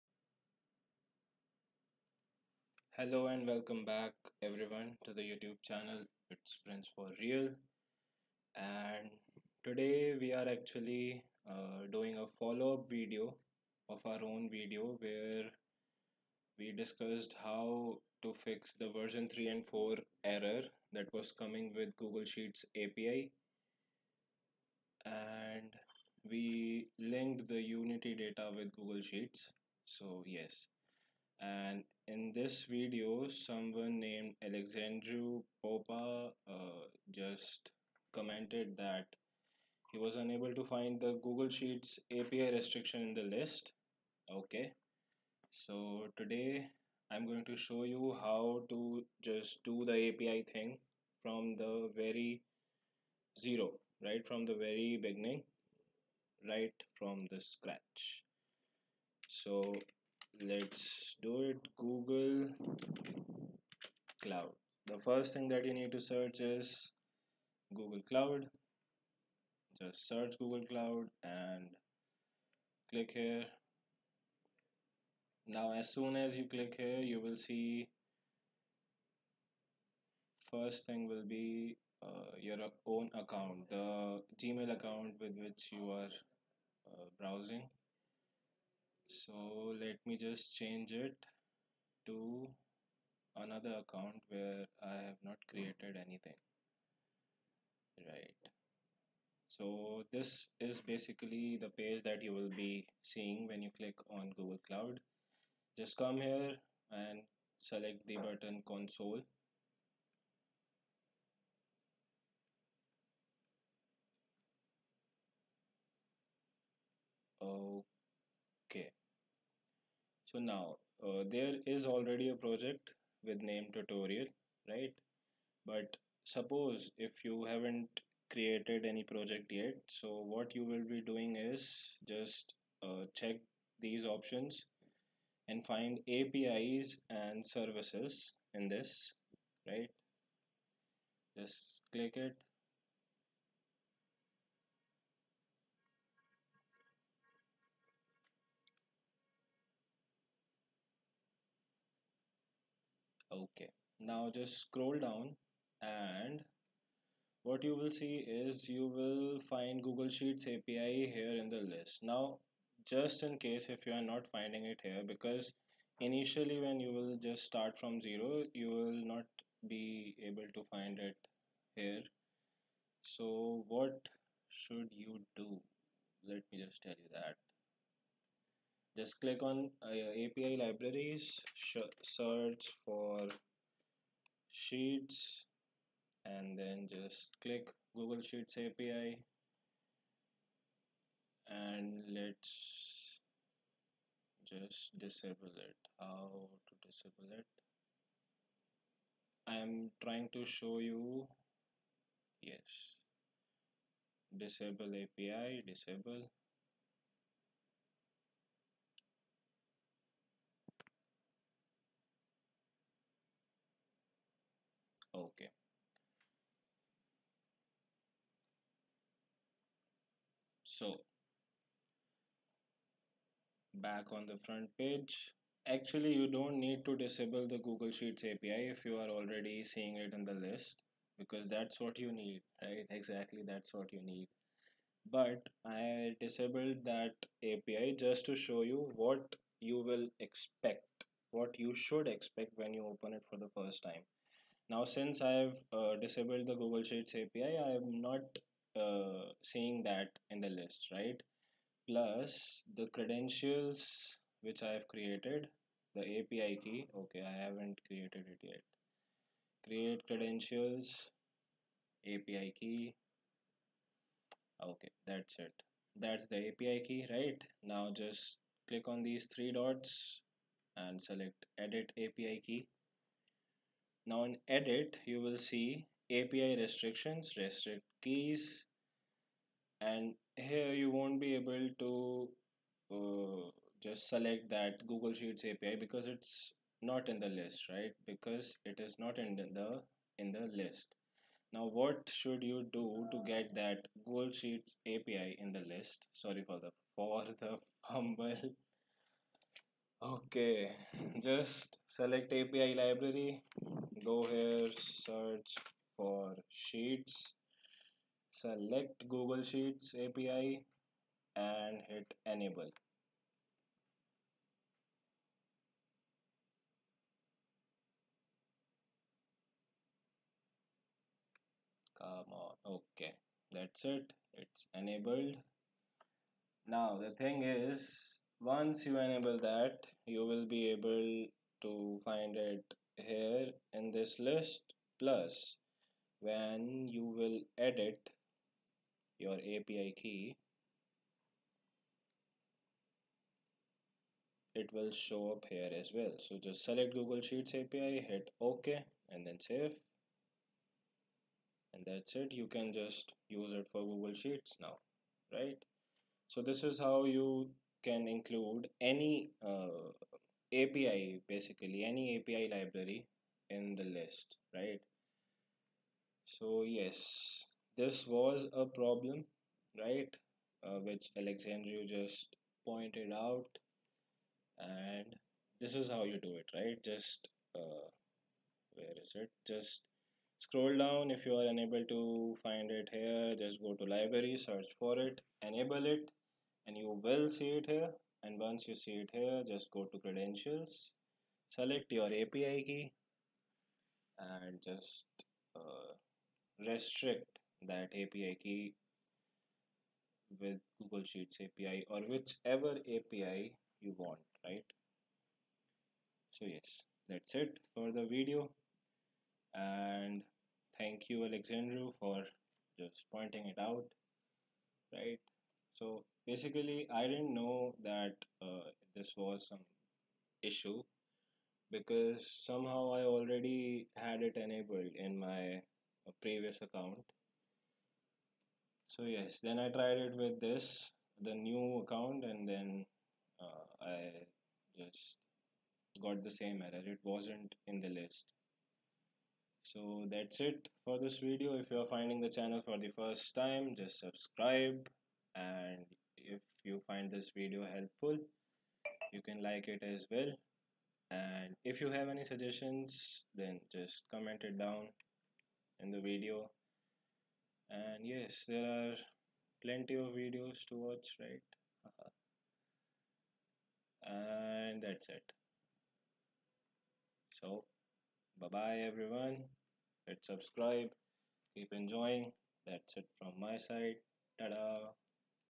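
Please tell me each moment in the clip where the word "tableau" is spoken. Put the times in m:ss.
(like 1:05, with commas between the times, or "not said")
not said.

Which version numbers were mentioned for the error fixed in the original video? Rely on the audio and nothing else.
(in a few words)
3 and 4.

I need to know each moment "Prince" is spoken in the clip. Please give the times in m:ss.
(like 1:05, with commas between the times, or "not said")
0:06.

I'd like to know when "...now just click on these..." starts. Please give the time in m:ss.
4:27.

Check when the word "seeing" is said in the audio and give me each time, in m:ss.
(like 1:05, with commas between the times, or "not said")
1:43, 3:49, 4:09.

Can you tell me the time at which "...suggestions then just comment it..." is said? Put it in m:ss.
7:32.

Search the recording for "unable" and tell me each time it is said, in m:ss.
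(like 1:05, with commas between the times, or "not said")
0:40, 6:21.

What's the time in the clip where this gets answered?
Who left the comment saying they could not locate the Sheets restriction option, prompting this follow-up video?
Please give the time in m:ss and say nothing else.
0:34.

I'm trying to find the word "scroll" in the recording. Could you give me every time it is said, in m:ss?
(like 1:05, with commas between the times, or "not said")
2:34, 6:20.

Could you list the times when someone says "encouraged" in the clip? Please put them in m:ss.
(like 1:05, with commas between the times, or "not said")
not said.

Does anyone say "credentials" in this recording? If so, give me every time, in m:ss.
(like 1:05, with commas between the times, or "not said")
4:12, 4:20, 6:29.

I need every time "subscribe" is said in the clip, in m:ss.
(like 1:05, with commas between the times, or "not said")
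7:23, 7:50.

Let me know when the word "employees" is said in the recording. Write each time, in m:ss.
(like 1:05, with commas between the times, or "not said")
not said.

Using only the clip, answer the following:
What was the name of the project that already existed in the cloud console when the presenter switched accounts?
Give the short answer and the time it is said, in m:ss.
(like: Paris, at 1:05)
tutorial, at 2:03.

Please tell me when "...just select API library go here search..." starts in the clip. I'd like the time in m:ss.
5:01.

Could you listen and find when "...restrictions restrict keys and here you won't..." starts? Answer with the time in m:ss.
4:36.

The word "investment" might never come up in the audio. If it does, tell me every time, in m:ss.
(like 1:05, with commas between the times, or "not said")
not said.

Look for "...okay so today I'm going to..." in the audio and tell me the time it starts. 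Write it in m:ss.
0:44.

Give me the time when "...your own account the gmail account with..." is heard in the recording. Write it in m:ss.
1:22.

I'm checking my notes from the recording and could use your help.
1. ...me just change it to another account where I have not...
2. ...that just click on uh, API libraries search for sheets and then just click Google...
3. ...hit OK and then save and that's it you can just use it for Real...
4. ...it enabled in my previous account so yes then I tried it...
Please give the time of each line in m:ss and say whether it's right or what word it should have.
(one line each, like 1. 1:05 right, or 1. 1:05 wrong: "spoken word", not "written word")
1. 1:30 right
2. 2:57 right
3. 5:48 wrong: "Google", not "Real"
4. 7:04 right.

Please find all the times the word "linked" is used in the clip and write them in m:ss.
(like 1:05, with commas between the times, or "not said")
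0:26.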